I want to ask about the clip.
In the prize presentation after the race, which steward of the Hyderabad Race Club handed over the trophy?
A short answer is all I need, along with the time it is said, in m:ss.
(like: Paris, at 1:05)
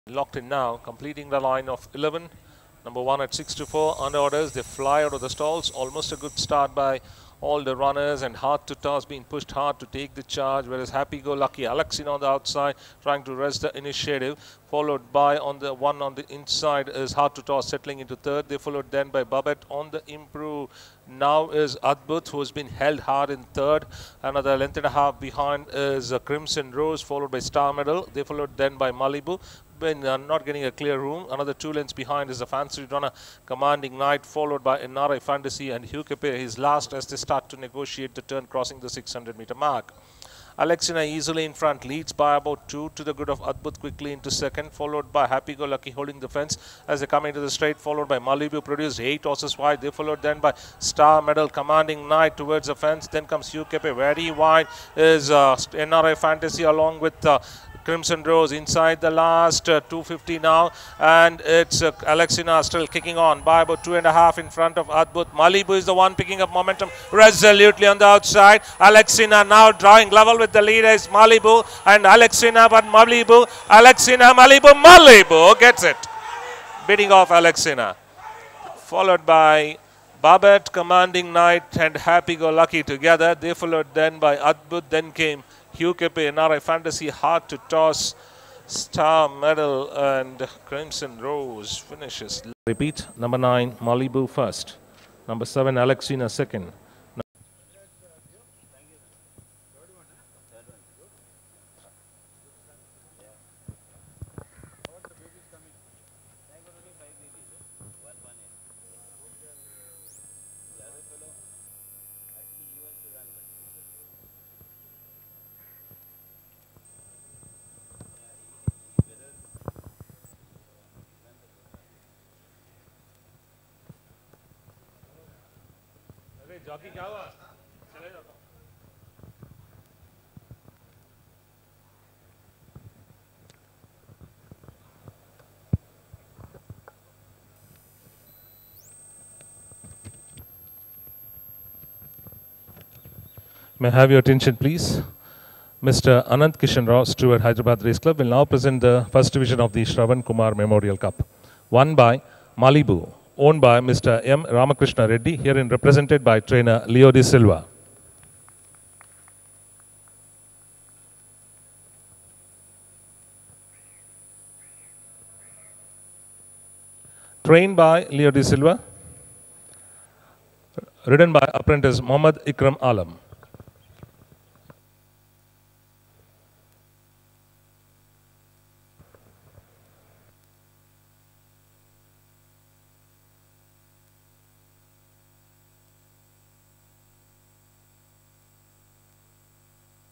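Anant Kishan Rao, at 2:26.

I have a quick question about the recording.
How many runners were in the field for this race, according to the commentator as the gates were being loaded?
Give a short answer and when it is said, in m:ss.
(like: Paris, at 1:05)
11, at 0:01.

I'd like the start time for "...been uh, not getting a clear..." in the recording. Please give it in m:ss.
0:29.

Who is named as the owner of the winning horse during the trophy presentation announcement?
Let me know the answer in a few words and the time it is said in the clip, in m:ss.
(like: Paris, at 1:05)
M. Ramakrishna Reddy, at 2:34.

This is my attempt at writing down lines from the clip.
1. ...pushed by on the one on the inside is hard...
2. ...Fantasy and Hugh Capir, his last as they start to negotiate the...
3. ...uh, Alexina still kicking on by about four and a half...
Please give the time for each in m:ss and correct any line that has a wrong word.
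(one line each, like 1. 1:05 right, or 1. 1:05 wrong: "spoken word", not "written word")
1. 0:14 wrong: "followed", not "pushed"
2. 0:35 right
3. 1:01 wrong: "two", not "four".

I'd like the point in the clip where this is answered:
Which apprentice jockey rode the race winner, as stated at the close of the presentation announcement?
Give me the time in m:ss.
2:51.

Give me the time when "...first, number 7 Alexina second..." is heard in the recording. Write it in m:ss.
1:34.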